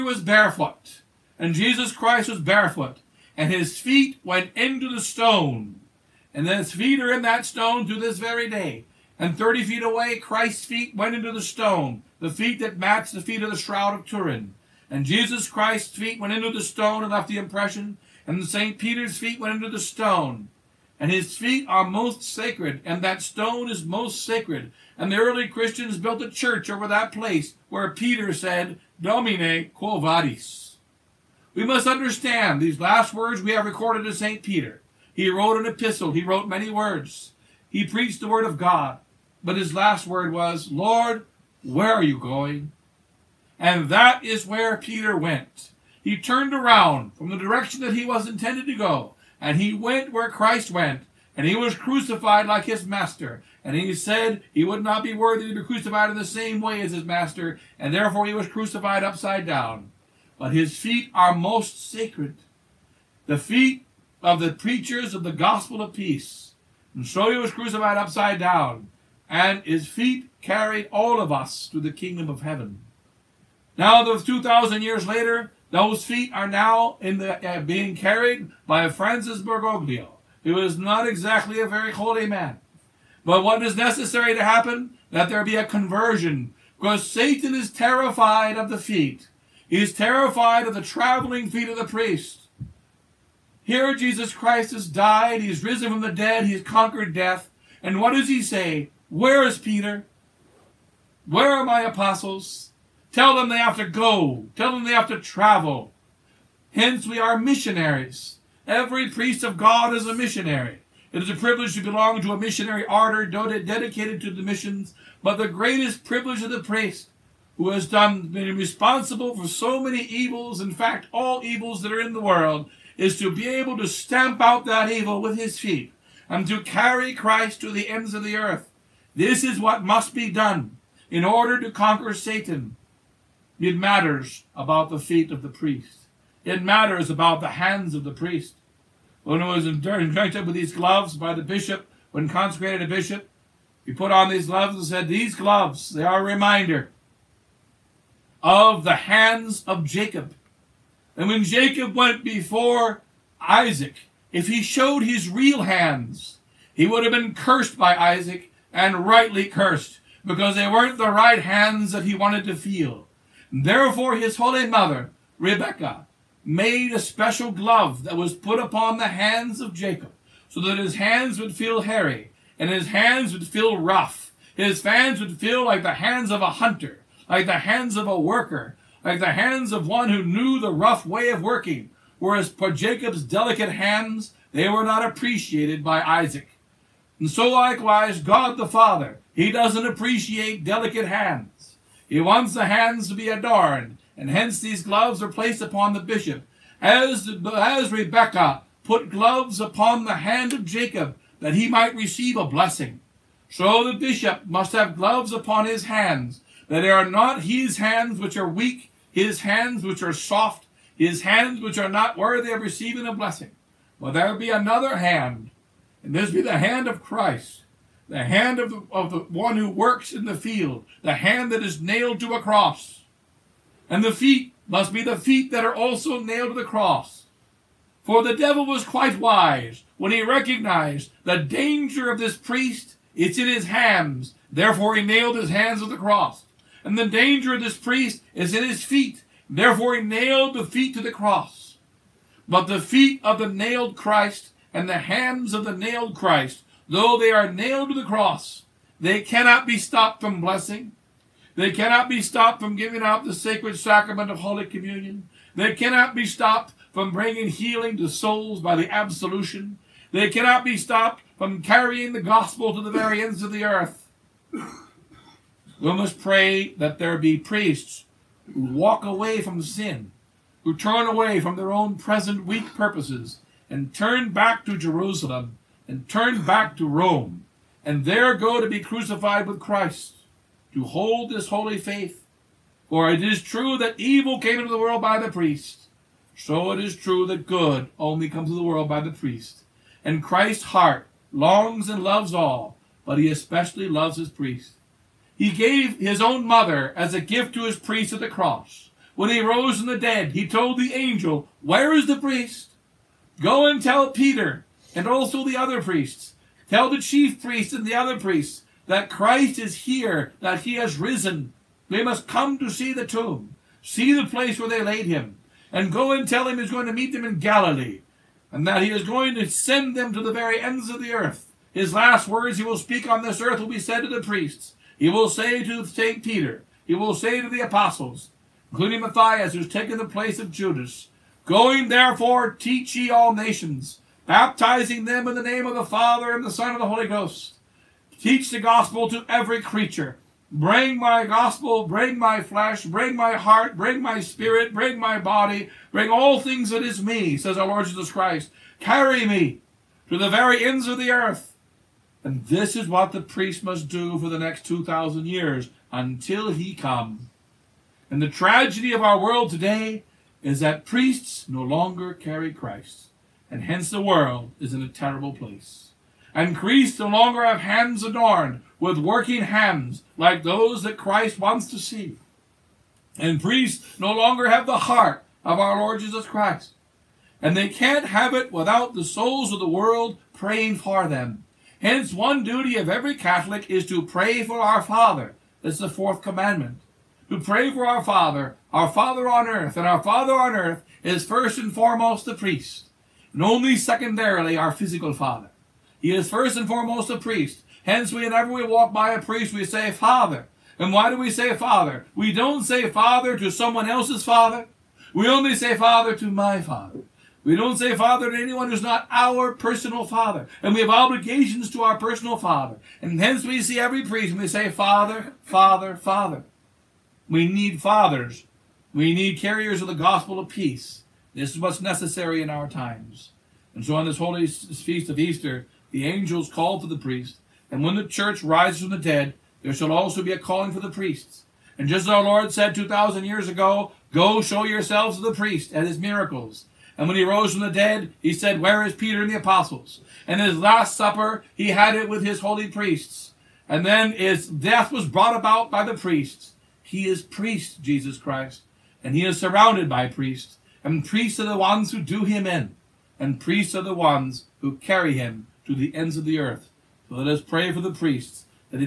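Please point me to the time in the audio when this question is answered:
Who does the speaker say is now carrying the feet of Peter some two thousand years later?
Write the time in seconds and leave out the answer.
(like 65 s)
78 s.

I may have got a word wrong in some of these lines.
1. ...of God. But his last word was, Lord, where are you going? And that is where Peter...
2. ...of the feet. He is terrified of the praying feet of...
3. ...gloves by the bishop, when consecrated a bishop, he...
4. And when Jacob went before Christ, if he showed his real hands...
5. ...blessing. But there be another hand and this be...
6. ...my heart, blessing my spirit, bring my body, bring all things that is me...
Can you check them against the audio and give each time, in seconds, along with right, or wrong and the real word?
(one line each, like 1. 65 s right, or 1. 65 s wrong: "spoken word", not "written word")
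1. 38 s right
2. 88 s wrong: "traveling", not "praying"
3. 140 s right
4. 151 s wrong: "Isaac", not "Christ"
5. 213 s right
6. 343 s wrong: "bring", not "blessing".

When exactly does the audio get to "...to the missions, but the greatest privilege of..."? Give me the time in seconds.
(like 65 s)
114 s.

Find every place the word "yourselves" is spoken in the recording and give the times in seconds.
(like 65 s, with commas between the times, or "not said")
434 s.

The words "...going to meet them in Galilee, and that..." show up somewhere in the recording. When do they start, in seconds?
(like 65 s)
316 s.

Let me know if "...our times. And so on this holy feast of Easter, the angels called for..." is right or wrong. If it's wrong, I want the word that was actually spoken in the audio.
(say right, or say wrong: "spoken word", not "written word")
right.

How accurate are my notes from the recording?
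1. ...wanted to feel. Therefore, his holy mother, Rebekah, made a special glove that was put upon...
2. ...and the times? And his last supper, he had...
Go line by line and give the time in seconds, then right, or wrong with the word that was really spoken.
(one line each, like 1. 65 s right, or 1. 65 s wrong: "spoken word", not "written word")
1. 162 s right
2. 439 s wrong: "apostles", not "times".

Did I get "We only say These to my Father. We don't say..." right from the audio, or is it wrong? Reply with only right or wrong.
wrong.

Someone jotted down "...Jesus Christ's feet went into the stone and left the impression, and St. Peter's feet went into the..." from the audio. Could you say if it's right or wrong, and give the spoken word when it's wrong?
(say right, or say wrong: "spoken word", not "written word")
right.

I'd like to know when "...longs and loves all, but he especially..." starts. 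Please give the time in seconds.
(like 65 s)
291 s.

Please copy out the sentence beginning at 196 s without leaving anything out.
As, as Rebekah put gloves upon the hand of Jacob, that he might receive a blessing.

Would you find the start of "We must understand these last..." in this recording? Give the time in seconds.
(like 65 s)
31 s.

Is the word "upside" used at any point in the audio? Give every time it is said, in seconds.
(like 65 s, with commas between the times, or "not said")
59 s, 67 s.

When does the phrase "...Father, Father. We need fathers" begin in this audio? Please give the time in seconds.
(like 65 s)
415 s.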